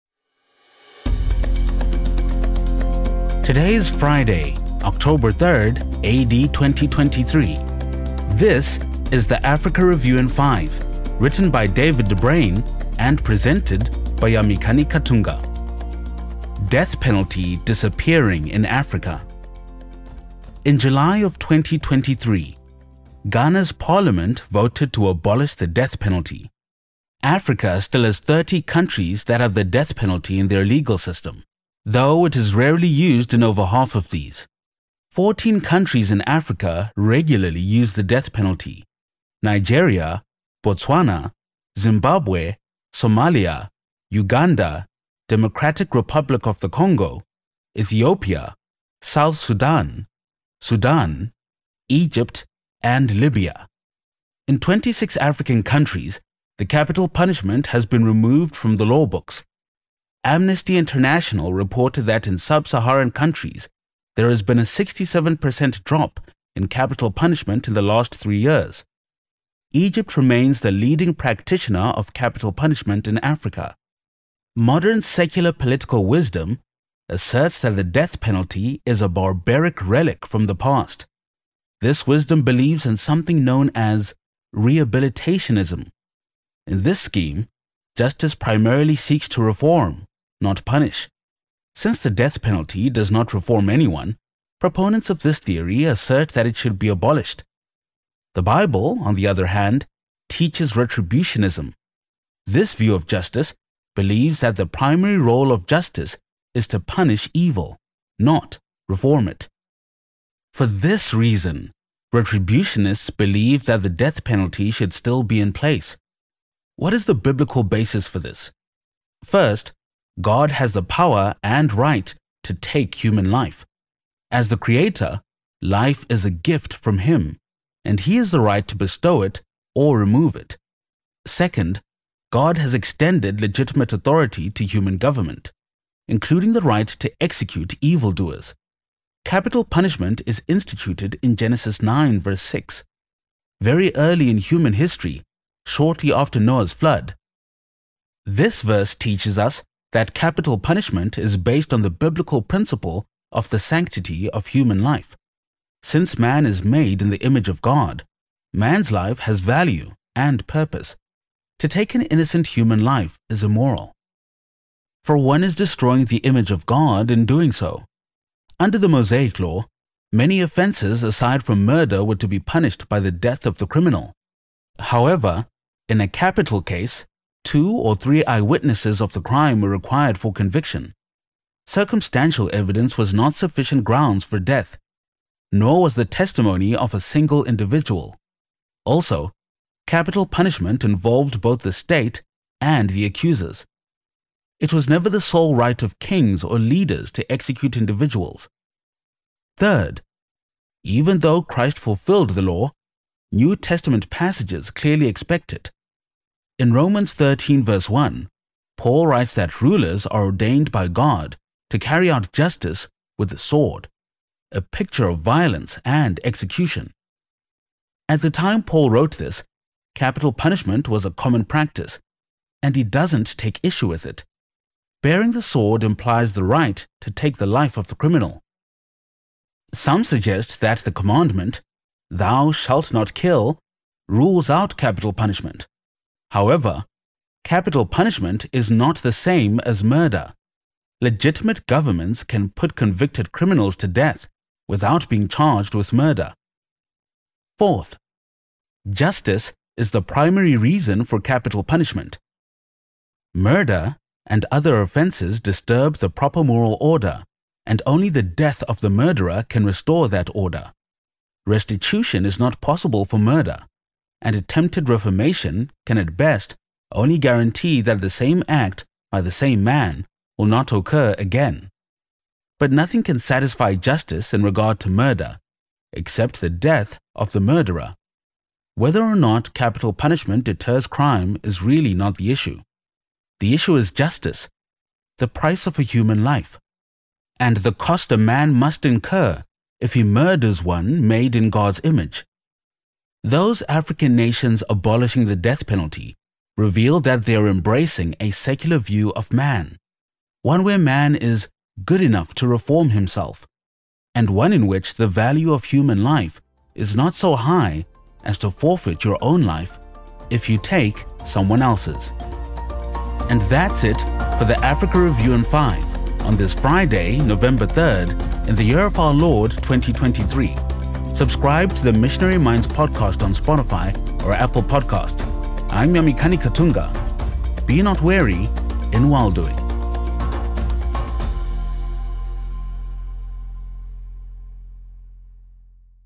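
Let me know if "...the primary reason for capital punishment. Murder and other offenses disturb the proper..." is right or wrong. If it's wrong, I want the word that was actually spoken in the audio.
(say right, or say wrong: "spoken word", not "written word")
right.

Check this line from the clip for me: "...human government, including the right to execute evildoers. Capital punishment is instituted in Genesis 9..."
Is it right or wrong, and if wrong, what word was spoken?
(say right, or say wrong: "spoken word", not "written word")
right.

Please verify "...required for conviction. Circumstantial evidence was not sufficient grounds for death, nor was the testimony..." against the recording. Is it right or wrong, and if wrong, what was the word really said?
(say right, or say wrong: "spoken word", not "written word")
right.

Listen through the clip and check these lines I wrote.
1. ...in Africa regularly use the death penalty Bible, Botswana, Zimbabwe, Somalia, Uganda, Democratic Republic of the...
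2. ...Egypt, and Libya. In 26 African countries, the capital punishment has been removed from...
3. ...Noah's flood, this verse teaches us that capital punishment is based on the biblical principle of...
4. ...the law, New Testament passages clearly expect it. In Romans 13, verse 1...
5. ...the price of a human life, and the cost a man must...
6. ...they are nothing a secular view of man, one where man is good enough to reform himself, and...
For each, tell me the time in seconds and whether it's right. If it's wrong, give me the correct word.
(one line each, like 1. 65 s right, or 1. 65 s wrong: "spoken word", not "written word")
1. 36 s wrong: "Nigeria", not "Bible"
2. 51 s right
3. 146 s right
4. 202 s right
5. 285 s right
6. 297 s wrong: "embracing", not "nothing".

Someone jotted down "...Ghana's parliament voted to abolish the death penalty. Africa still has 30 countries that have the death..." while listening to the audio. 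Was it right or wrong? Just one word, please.
right.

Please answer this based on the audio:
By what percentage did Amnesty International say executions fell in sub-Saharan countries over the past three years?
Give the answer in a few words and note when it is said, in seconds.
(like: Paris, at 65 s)
67%, at 64 s.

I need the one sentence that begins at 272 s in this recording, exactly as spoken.
But nothing can satisfy justice in regard to murder, except the death of the murderer.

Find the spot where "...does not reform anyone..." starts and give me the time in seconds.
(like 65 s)
92 s.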